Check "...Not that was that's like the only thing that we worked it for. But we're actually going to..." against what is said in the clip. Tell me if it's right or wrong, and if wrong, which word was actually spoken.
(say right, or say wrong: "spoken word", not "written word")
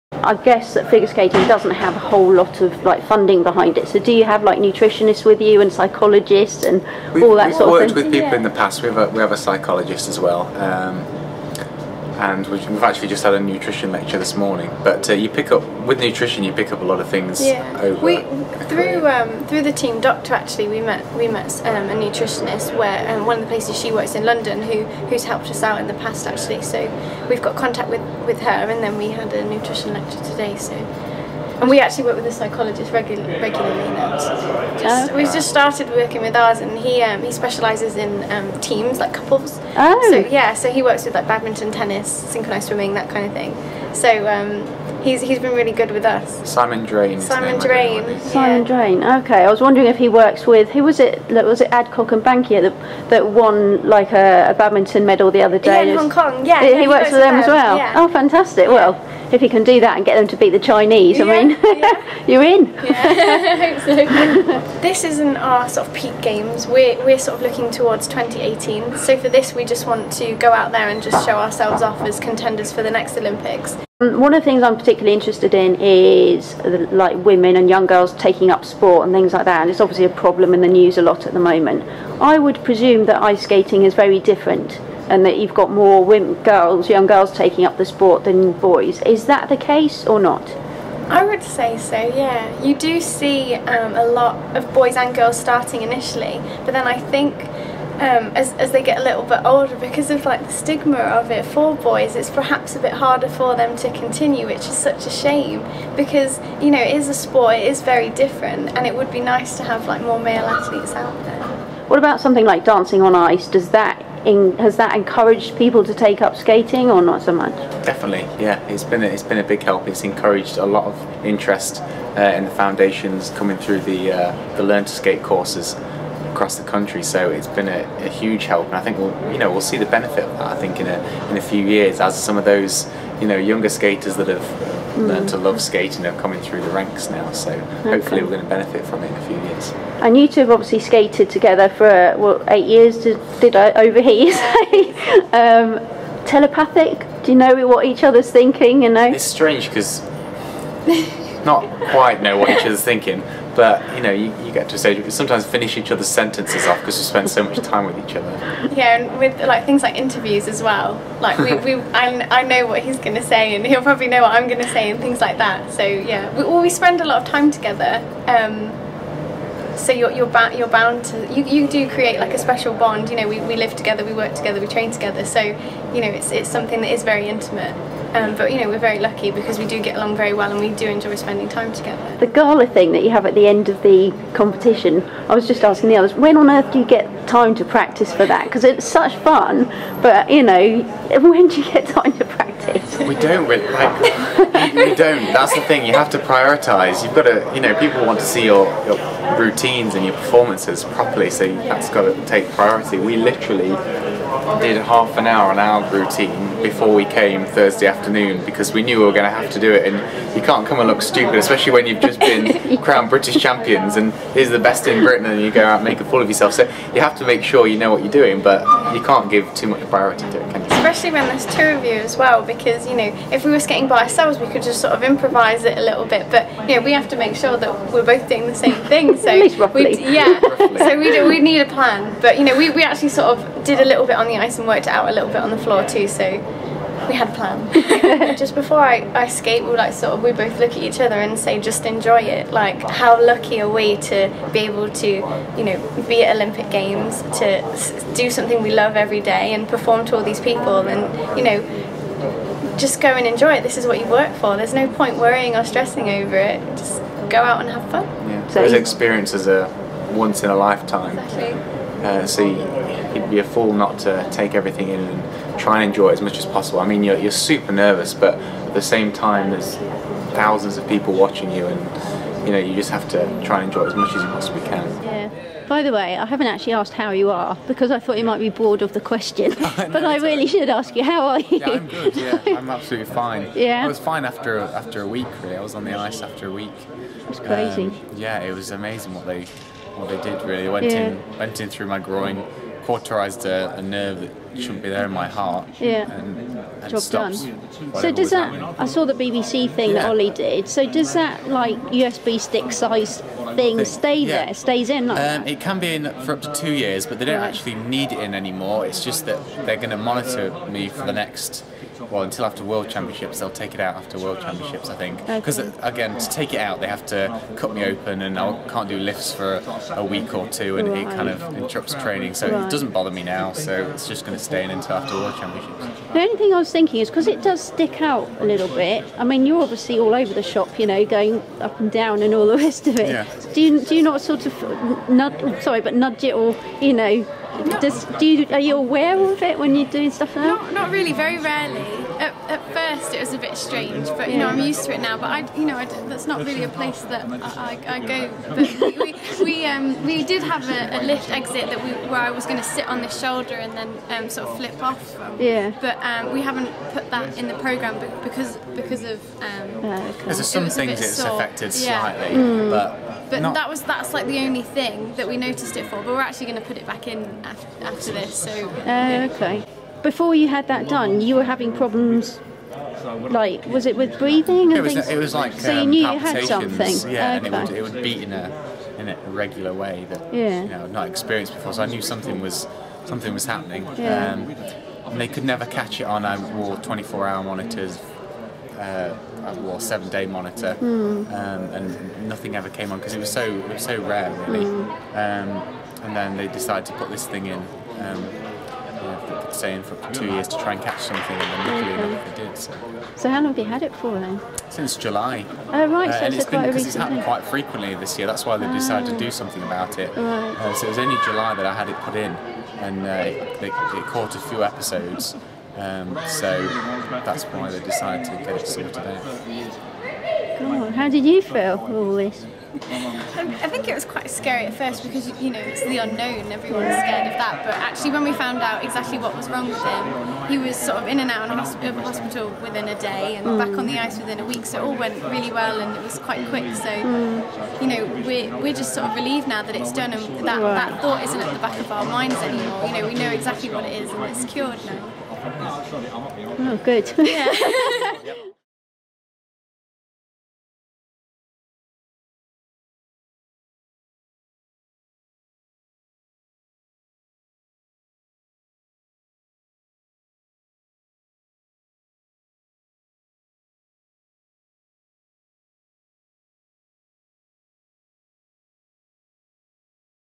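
wrong: "noticed", not "worked".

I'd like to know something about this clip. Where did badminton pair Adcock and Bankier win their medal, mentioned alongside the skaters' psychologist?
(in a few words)
Hong Kong.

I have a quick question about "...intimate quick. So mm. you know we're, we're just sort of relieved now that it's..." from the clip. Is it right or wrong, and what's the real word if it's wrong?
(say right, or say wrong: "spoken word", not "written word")
wrong: "quite", not "intimate".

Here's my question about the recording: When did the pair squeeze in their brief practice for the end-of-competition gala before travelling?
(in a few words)
Thursday afternoon.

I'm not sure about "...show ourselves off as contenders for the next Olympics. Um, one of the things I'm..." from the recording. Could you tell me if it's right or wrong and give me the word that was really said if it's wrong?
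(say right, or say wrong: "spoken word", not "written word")
right.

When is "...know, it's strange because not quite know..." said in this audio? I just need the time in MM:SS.
02:28.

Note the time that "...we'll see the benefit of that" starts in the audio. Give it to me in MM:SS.
02:09.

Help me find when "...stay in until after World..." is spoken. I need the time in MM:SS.
05:24.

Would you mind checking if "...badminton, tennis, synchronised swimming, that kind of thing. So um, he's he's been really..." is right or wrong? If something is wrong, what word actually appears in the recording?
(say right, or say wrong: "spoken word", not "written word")
right.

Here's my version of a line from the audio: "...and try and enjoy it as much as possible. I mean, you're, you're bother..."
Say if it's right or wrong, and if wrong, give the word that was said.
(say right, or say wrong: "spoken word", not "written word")
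wrong: "super", not "bother".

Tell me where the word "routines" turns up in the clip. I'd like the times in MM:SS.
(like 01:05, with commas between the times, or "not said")
03:19, 03:25.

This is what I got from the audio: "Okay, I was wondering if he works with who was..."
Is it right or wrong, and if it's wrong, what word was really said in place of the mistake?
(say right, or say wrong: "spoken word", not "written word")
right.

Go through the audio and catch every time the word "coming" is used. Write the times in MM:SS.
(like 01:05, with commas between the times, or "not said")
02:03, 02:16.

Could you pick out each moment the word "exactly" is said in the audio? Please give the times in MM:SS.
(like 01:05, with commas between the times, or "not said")
04:21, 07:08, 07:23.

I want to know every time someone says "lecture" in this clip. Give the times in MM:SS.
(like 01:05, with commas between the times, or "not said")
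00:13, 00:29.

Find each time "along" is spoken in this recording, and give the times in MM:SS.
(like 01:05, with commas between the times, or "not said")
02:59.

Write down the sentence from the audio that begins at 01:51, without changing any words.
What about something like dancing on ice?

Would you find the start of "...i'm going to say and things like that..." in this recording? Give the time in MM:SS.
02:44.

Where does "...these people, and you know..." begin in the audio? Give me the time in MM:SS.
04:10.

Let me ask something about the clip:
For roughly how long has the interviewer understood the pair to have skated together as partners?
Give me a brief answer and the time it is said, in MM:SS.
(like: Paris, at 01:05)
8 years, at 02:22.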